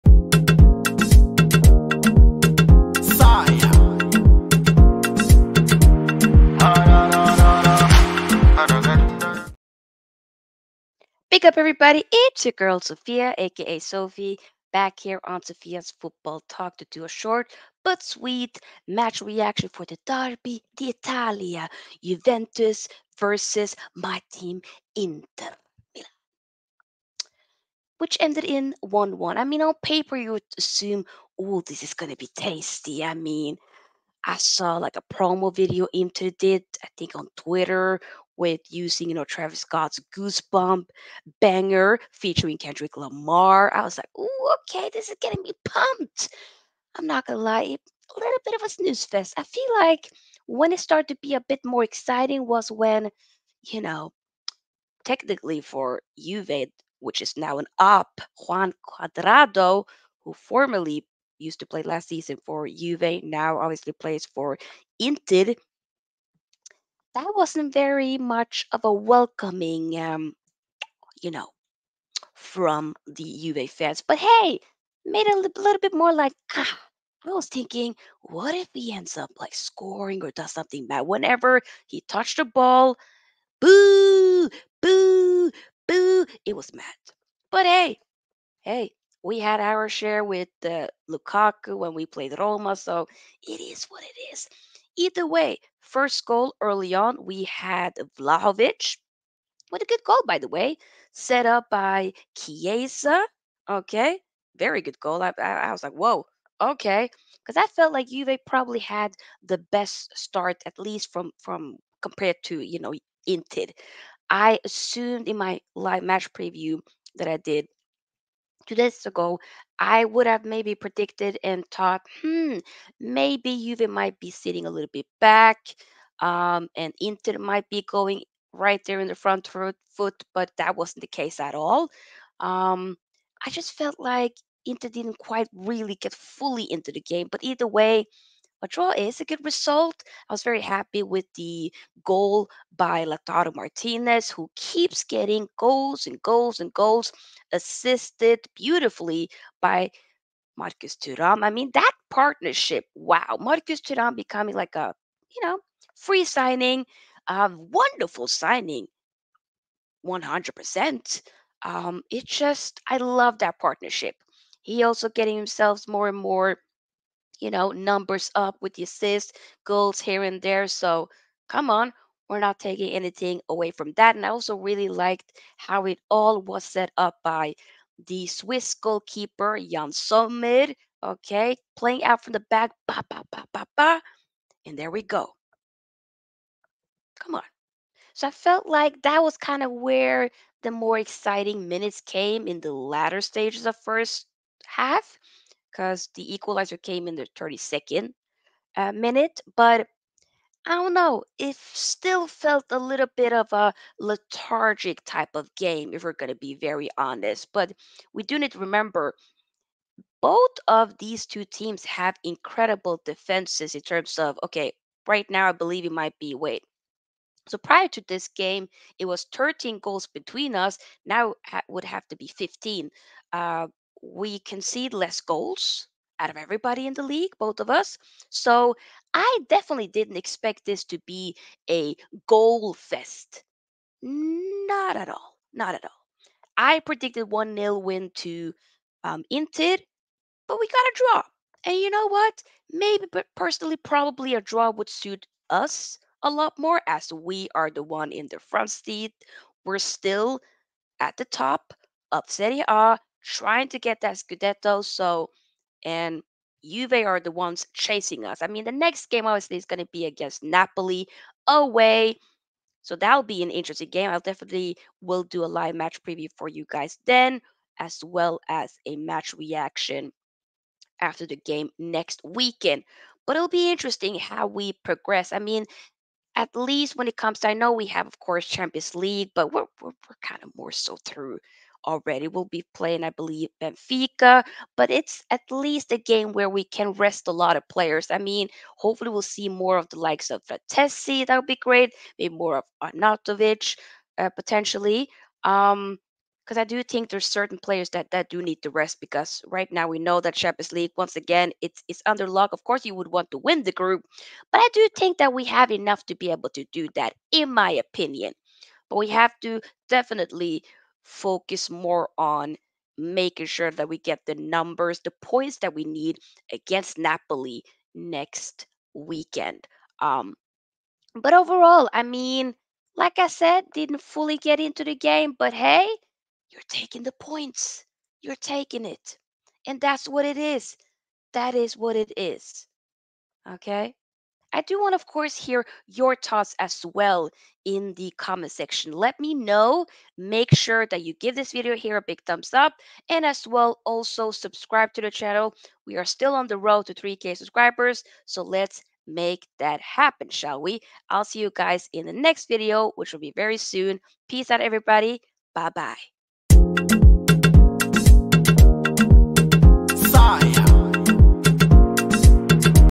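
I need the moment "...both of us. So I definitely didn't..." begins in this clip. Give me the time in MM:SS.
03:47.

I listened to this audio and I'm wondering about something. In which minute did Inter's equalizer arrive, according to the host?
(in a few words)
32nd.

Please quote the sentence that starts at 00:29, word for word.
I mean, on paper, you would assume, oh, this is going to be tasty.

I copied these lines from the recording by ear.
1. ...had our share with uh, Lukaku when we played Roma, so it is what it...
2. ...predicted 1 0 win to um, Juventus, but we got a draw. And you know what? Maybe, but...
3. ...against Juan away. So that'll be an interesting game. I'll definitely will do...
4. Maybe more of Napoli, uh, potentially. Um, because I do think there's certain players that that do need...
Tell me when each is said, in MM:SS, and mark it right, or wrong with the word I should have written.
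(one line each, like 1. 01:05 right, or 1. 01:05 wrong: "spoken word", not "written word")
1. 01:29 right
2. 03:56 wrong: "Inter", not "Juventus"
3. 04:20 wrong: "Napoli", not "Juan"
4. 04:52 wrong: "Arnautovic", not "Napoli".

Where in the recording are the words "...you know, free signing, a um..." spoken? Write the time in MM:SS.
02:35.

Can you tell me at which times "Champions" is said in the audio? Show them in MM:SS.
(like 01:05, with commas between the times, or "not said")
04:38, 05:00.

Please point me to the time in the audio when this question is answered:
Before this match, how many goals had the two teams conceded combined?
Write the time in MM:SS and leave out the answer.
03:39.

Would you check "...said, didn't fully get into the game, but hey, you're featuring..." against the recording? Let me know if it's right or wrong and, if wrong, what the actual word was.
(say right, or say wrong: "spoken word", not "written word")
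wrong: "taking", not "featuring".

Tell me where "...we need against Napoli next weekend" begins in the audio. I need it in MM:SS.
05:15.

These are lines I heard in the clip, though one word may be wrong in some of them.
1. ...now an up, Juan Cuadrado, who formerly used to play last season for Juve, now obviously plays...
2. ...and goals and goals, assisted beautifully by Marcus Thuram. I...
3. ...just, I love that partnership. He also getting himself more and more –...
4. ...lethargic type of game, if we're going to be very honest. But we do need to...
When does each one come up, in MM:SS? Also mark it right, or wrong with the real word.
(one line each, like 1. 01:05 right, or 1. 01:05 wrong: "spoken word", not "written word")
1. 00:57 right
2. 02:26 right
3. 02:42 right
4. 03:23 right.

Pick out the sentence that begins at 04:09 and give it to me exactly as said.
We're still at the top of Serie A trying to get that Scudetto.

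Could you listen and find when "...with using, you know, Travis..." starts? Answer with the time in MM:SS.
00:38.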